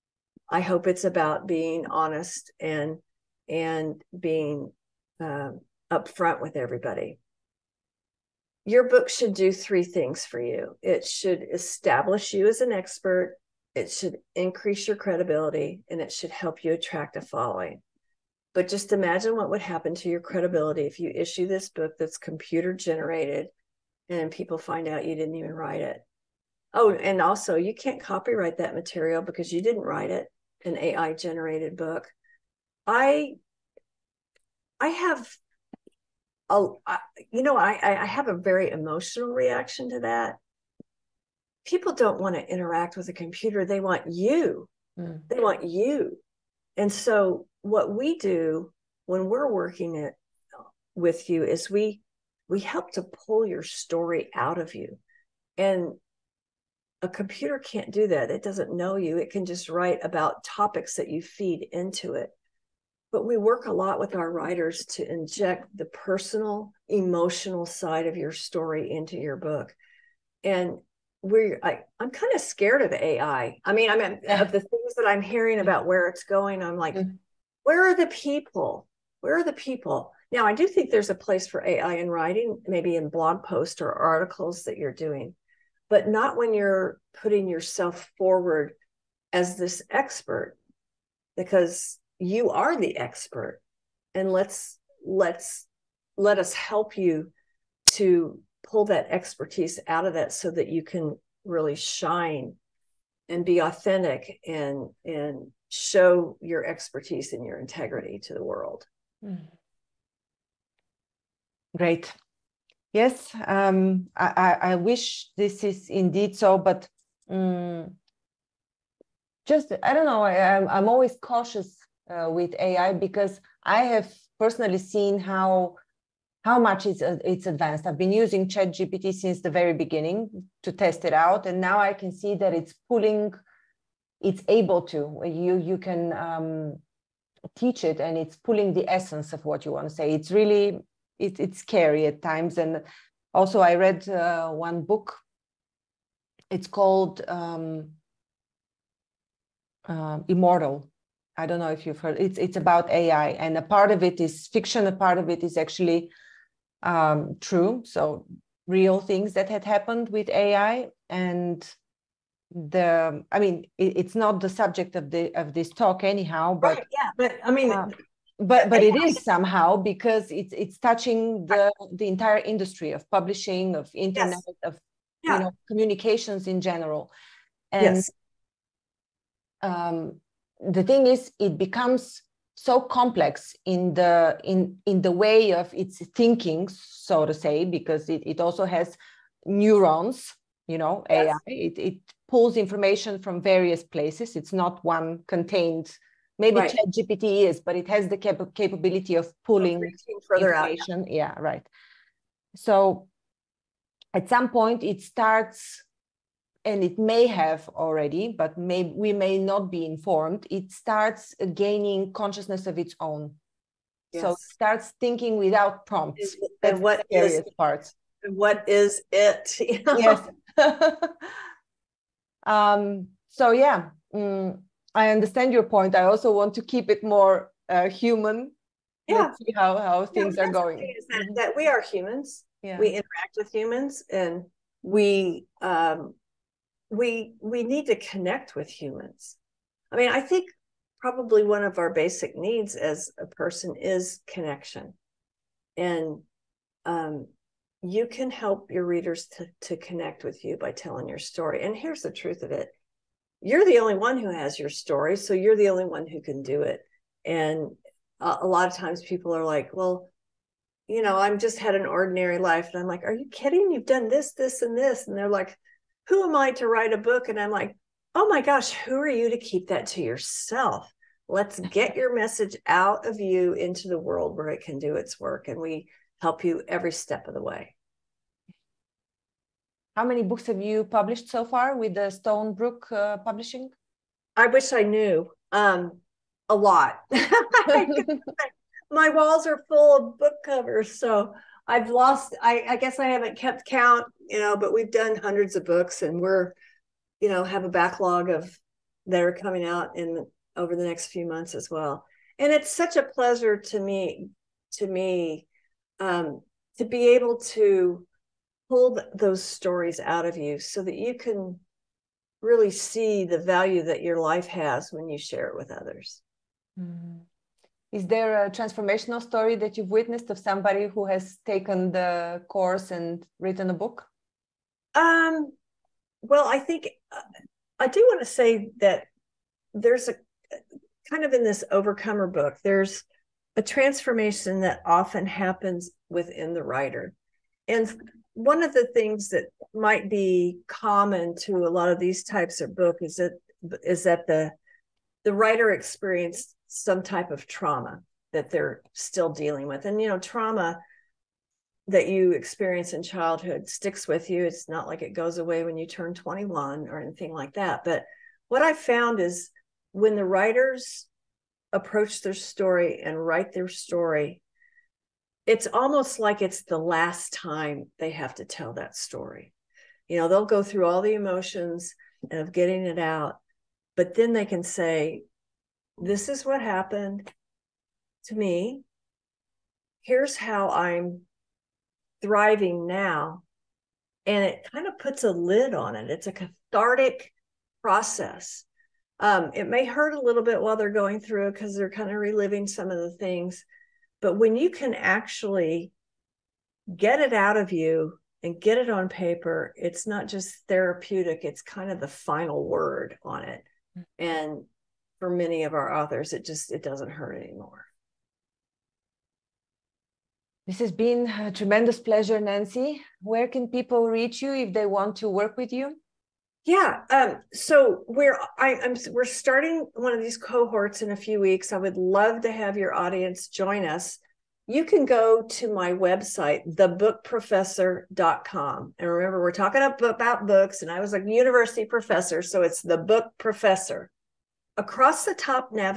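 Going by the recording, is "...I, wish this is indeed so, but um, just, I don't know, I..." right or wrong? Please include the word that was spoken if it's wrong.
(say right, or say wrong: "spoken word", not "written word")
right.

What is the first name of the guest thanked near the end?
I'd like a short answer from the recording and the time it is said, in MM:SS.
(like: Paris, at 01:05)
Nancy, at 06:52.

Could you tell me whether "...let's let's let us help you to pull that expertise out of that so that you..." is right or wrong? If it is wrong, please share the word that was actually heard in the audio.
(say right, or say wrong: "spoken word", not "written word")
right.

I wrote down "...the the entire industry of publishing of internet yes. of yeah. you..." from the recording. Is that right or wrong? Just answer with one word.
right.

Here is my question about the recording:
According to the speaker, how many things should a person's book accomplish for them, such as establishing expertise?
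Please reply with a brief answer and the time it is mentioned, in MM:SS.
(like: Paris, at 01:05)
3, at 00:09.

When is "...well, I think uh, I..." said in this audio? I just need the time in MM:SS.
05:26.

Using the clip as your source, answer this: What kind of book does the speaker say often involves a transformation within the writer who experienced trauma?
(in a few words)
Overcomer book.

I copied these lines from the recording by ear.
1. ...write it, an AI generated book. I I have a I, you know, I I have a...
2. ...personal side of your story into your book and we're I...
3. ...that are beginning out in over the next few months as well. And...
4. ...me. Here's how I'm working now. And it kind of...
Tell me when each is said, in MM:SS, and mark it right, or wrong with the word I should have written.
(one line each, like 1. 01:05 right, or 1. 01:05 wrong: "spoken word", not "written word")
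1. 00:29 right
2. 01:06 wrong: "emotional", not "personal"
3. 04:59 wrong: "coming", not "beginning"
4. 06:18 wrong: "thriving", not "working".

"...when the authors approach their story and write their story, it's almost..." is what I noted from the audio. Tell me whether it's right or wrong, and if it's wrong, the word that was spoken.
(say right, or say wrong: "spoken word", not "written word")
wrong: "writers", not "authors".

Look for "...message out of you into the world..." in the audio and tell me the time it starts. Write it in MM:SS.
04:32.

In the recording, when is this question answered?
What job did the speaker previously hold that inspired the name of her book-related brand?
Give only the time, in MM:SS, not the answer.
07:11.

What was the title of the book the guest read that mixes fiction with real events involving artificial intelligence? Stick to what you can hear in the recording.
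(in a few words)
Immortal.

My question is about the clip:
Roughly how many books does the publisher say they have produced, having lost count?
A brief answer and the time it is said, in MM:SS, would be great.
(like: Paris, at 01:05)
Hundreds, at 04:55.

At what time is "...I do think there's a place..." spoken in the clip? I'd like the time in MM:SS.
01:20.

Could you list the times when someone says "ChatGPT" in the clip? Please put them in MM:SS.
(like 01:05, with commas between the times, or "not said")
02:08, 03:16.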